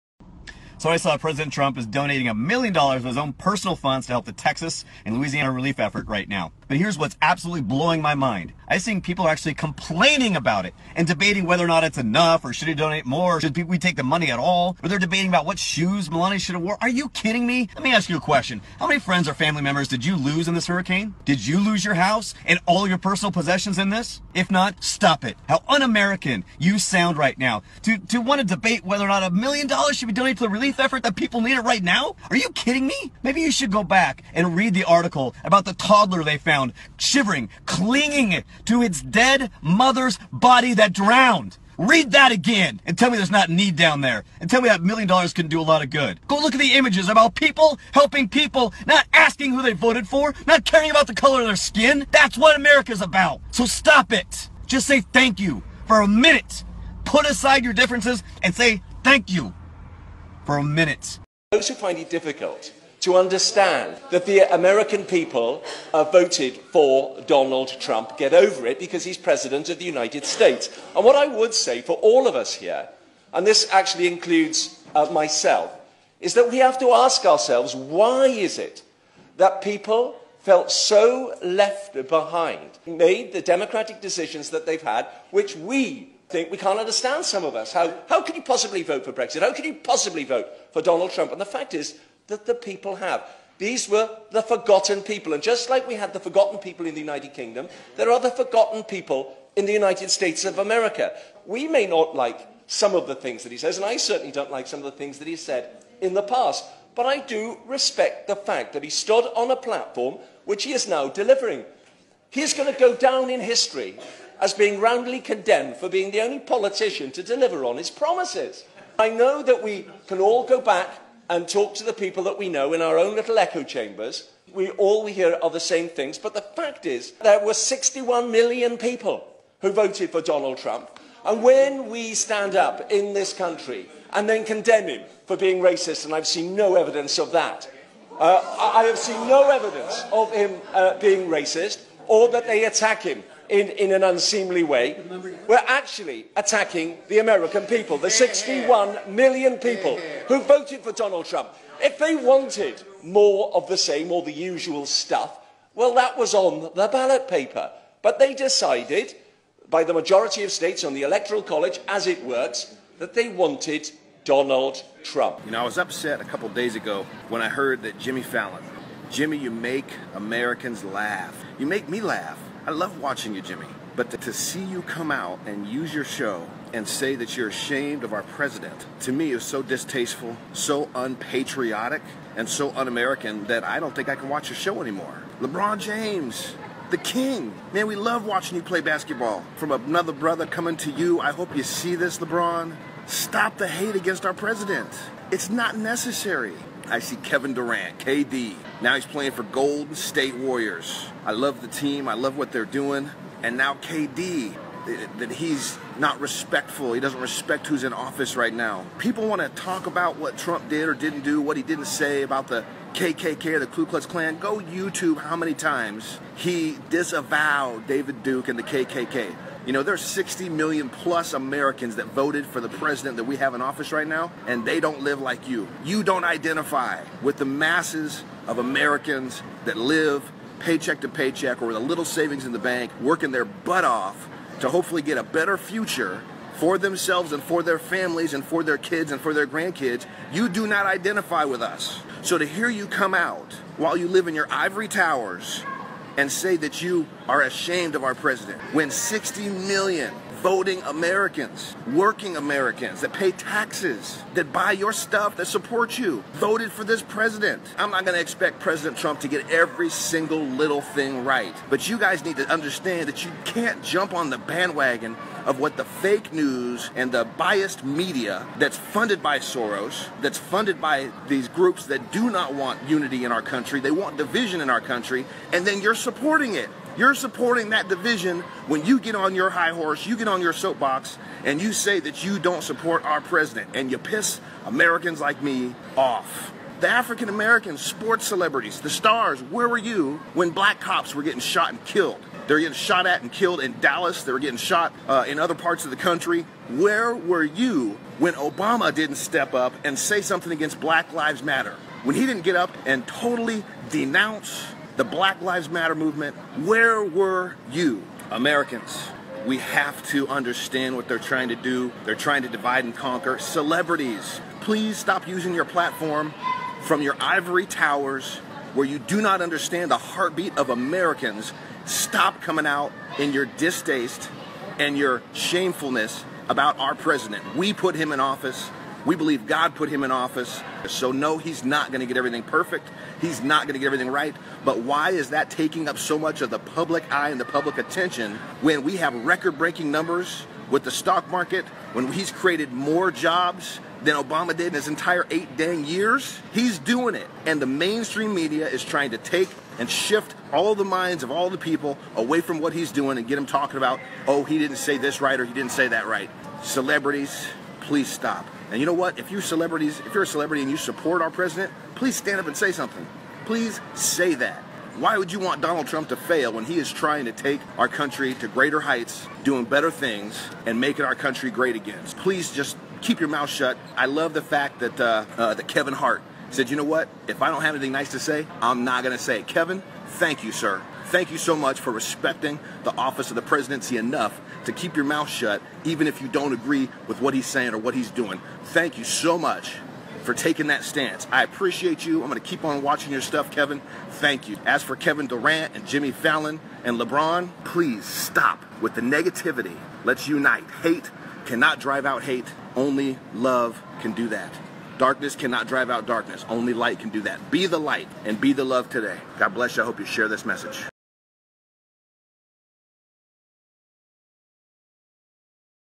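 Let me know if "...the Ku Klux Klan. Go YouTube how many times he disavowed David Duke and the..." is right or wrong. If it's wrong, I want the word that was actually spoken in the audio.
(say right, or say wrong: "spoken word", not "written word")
right.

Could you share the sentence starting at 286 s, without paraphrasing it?
The African American sports celebrities, the stars, where were you when black cops were getting shot and killed?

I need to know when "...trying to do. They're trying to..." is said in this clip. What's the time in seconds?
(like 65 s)
311 s.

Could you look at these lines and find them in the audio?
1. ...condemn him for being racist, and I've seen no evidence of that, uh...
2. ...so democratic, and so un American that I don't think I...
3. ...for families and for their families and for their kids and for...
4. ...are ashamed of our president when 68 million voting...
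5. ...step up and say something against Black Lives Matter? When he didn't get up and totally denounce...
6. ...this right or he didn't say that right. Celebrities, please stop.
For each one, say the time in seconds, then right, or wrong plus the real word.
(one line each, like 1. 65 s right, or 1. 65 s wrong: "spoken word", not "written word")
1. 134 s right
2. 180 s wrong: "unpatriotic", not "democratic"
3. 236 s wrong: "themselves", not "families"
4. 247 s wrong: "60", not "68"
5. 299 s right
6. 354 s right.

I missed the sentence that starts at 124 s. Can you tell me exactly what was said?
We all we hear are the same things, but the fact is there were 61 million people who voted for Donald Trump.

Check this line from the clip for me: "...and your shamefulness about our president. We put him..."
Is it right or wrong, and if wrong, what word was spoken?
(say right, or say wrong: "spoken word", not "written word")
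right.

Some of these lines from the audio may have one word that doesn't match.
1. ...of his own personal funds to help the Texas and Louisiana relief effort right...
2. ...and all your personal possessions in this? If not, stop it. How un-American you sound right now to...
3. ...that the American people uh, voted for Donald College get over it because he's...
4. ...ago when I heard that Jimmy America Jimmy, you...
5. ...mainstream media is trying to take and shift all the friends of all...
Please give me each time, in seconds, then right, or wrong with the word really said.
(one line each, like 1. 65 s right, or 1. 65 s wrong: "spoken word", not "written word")
1. 3 s right
2. 22 s right
3. 64 s wrong: "Trump", not "College"
4. 166 s wrong: "Fallon", not "America"
5. 347 s wrong: "minds", not "friends".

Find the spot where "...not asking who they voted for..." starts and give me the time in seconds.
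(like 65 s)
48 s.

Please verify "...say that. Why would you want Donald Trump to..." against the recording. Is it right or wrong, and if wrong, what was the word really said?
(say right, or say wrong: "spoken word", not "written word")
right.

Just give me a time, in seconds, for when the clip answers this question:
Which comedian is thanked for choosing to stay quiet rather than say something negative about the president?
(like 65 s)
375 s.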